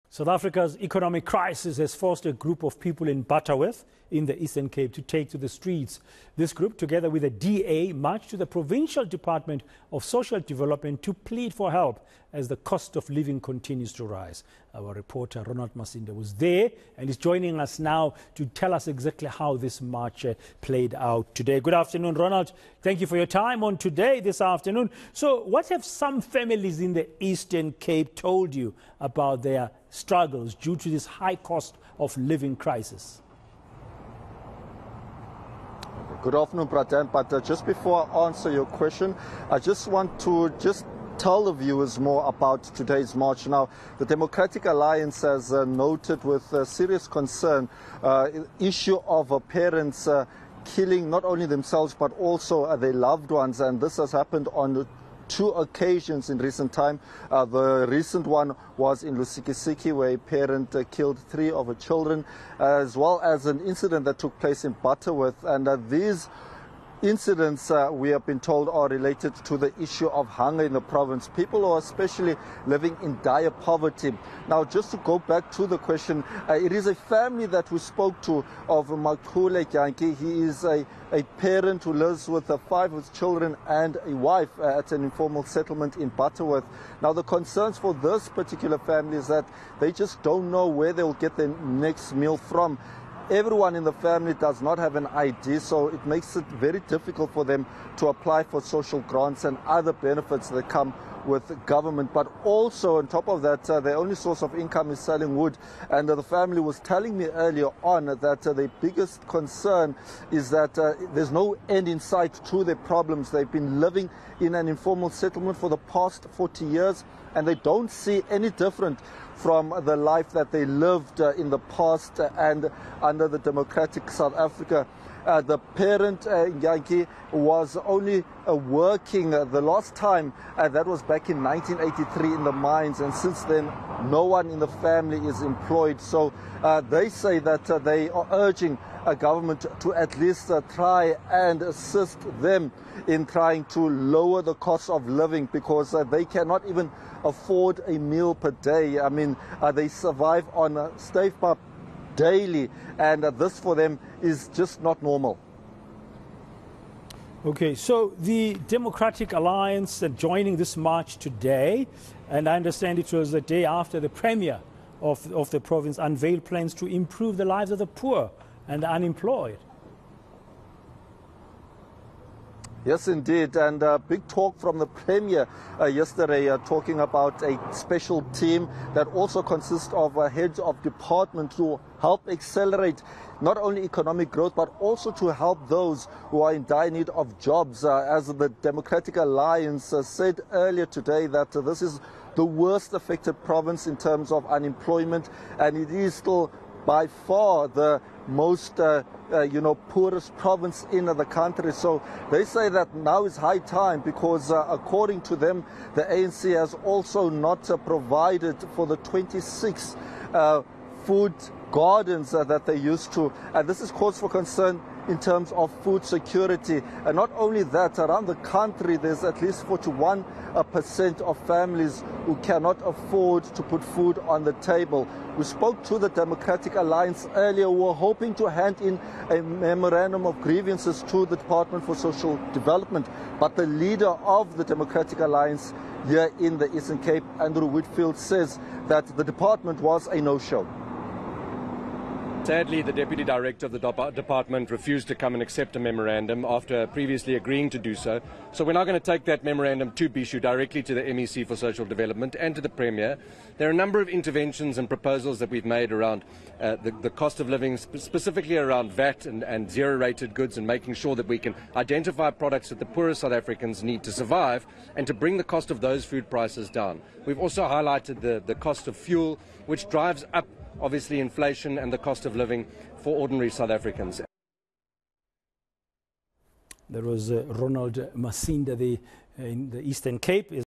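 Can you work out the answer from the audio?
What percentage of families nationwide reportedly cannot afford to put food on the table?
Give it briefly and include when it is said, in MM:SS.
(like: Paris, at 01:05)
41%, at 03:39.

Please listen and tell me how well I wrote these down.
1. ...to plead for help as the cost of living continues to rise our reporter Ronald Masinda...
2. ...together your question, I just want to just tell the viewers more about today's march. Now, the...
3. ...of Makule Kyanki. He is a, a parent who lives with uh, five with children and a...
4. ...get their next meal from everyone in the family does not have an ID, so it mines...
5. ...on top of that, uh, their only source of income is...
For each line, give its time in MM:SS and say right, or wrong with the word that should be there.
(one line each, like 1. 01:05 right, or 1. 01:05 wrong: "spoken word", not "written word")
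1. 00:11 right
2. 00:38 wrong: "answer", not "together"
3. 01:18 right
4. 01:31 wrong: "makes", not "mines"
5. 01:42 right.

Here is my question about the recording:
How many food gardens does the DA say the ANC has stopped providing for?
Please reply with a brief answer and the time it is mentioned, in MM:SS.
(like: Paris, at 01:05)
26, at 03:28.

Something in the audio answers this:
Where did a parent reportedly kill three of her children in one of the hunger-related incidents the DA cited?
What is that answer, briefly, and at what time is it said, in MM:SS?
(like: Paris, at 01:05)
Lusikisiki, at 00:59.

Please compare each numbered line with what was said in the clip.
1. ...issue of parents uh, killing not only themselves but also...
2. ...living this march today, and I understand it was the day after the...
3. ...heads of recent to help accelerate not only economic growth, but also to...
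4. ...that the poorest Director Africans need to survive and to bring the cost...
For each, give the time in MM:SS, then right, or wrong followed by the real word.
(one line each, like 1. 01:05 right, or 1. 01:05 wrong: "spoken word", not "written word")
1. 00:48 right
2. 02:40 wrong: "joining", not "living"
3. 03:00 wrong: "department", not "recent"
4. 04:22 wrong: "South", not "Director".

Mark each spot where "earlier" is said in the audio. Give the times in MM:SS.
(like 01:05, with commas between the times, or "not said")
01:47, 03:10, 03:47.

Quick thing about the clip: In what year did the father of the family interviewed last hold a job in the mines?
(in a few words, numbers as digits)
1983.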